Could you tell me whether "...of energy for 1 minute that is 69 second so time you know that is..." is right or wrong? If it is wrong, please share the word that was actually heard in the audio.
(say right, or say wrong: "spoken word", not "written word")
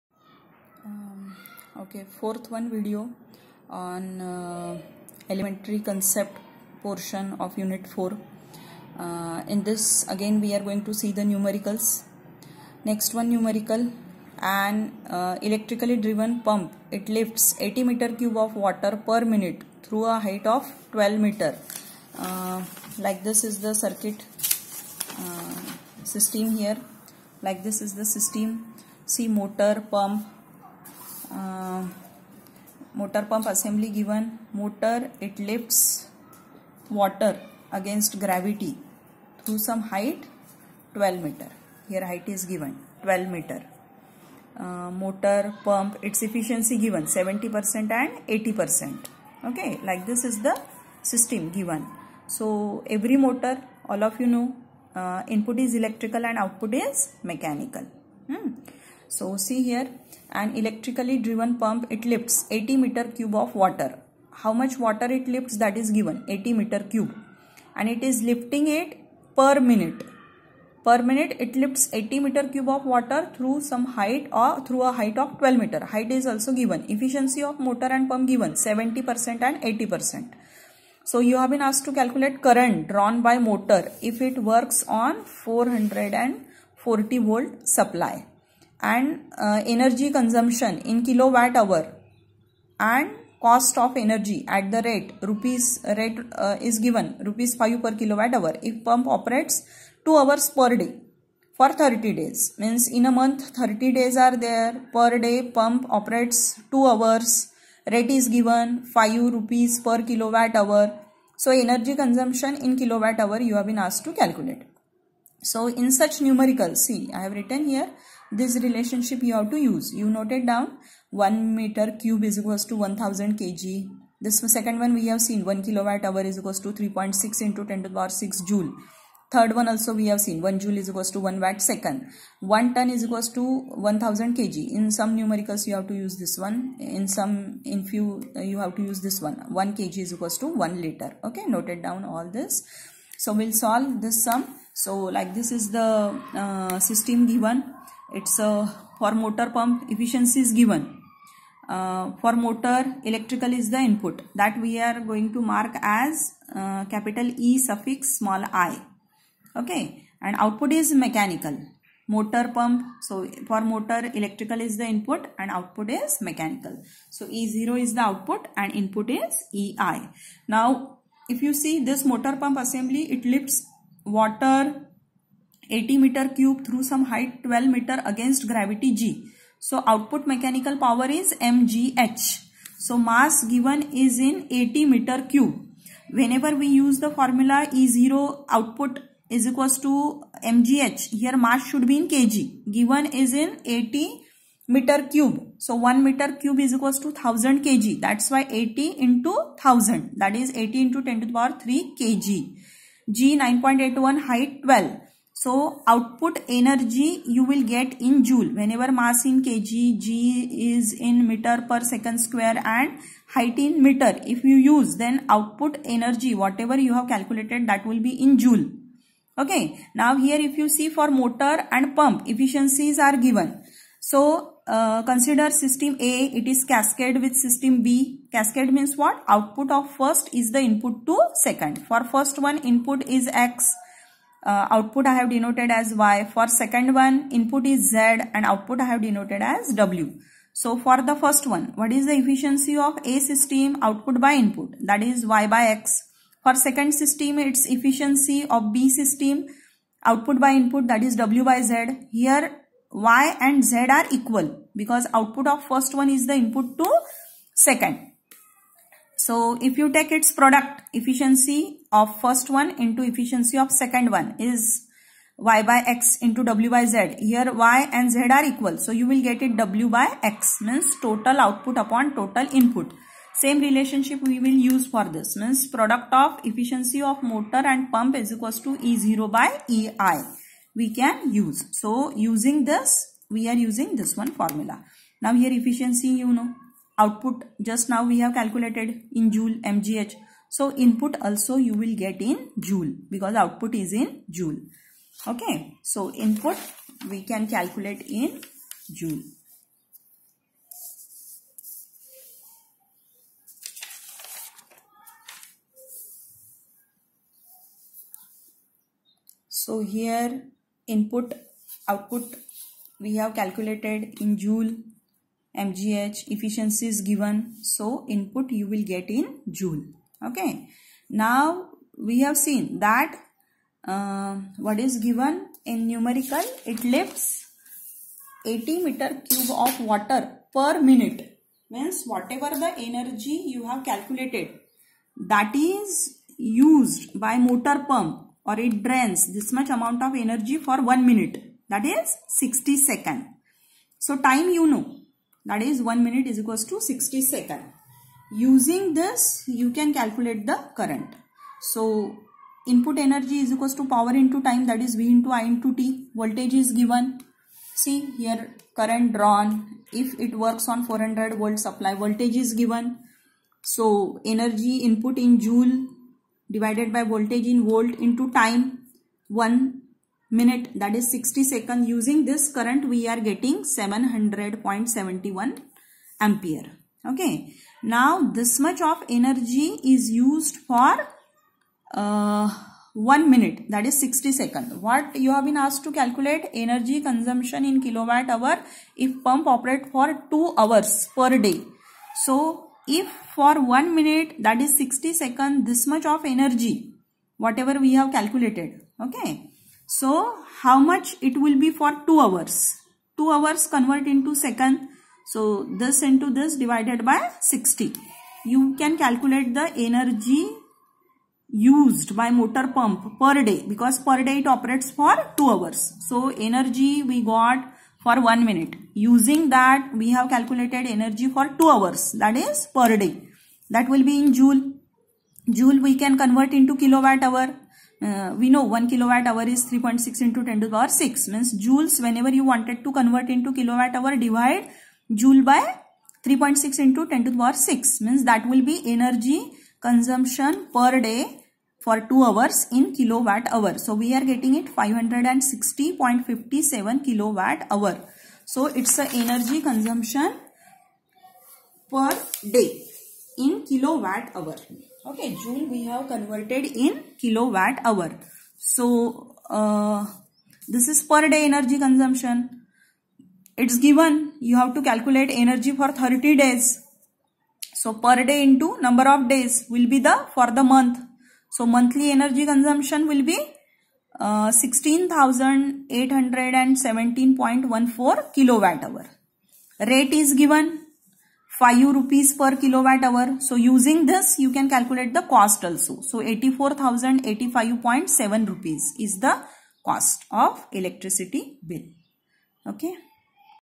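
wrong: "60", not "69".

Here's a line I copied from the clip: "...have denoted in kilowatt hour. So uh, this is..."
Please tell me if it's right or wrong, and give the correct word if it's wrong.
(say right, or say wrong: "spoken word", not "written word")
wrong: "converted", not "denoted".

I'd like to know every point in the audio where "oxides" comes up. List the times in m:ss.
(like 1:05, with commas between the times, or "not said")
not said.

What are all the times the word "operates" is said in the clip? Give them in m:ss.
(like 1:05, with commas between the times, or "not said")
1:39, 1:45, 6:29, 6:54.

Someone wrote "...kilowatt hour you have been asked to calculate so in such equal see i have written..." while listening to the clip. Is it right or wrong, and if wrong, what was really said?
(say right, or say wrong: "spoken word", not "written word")
wrong: "numerical", not "equal".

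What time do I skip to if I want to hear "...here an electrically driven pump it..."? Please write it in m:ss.
0:59.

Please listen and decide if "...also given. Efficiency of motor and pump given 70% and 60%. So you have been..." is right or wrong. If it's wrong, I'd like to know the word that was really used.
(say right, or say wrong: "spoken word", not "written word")
wrong: "80", not "60".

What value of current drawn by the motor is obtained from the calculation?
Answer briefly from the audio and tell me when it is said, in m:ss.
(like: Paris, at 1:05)
700.71 amperes, at 6:13.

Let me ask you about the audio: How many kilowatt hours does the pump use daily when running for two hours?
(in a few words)
560.57 kWh.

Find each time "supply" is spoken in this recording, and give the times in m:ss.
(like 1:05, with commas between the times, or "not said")
1:27, 6:01.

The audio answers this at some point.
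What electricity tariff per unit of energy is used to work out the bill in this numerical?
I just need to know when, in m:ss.
1:37.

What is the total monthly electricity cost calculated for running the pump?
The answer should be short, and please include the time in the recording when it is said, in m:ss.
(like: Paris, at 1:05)
84,085.7 rupees, at 8:06.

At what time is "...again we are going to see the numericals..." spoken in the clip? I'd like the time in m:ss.
0:10.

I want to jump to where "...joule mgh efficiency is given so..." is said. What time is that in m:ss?
5:14.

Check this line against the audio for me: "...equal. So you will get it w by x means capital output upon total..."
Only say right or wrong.
wrong.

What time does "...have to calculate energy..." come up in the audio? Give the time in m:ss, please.
7:44.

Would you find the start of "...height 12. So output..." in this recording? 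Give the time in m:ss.
3:24.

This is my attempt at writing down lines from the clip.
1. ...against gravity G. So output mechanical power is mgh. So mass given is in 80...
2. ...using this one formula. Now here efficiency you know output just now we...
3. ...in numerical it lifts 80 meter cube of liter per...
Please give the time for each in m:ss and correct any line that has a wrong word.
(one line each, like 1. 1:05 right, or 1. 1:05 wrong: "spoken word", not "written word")
1. 2:58 right
2. 4:43 right
3. 5:25 wrong: "water", not "liter".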